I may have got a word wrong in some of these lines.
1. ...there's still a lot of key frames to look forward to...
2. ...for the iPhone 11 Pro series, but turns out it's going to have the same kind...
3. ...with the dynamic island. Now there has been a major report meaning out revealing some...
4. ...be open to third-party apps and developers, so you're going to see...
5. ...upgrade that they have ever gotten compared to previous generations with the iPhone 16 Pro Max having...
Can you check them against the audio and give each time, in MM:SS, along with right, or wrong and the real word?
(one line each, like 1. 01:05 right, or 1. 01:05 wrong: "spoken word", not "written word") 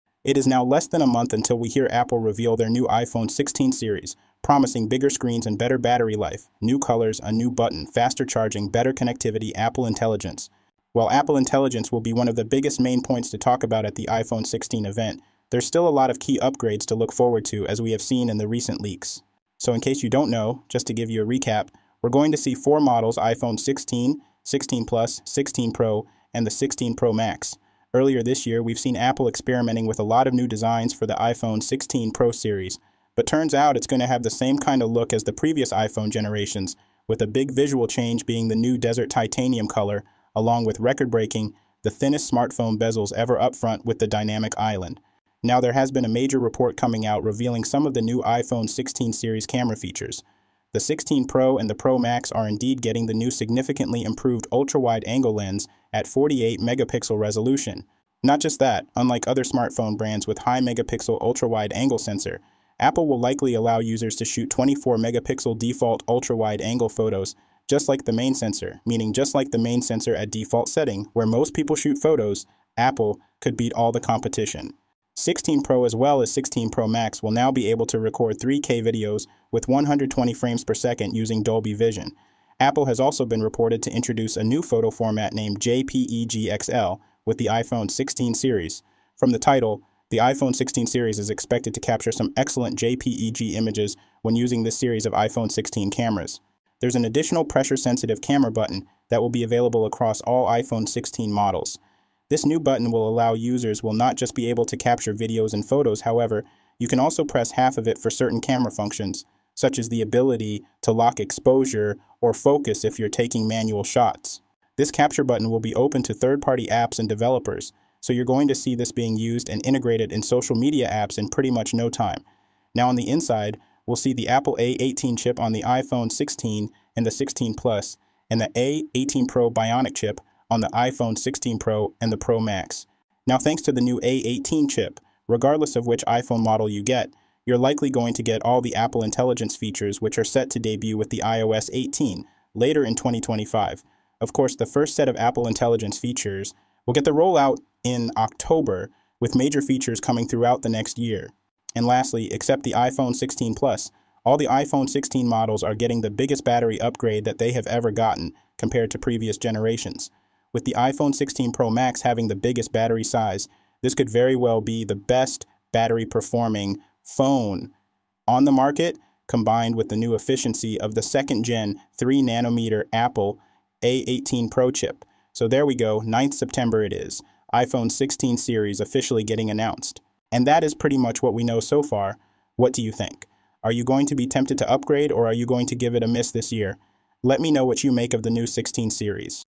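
1. 00:15 wrong: "upgrades", not "frames"
2. 00:30 wrong: "16", not "11"
3. 00:43 wrong: "coming", not "meaning"
4. 01:55 right
5. 02:36 right.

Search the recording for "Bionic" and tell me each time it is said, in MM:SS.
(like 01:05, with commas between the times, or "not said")
02:09.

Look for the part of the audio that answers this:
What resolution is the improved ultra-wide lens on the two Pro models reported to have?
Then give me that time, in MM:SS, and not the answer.
00:56.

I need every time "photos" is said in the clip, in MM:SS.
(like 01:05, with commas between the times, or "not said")
01:06, 01:11, 01:24, 01:45.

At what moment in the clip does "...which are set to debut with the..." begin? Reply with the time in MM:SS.
02:20.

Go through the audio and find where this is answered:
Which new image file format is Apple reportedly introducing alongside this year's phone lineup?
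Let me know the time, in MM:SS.
01:25.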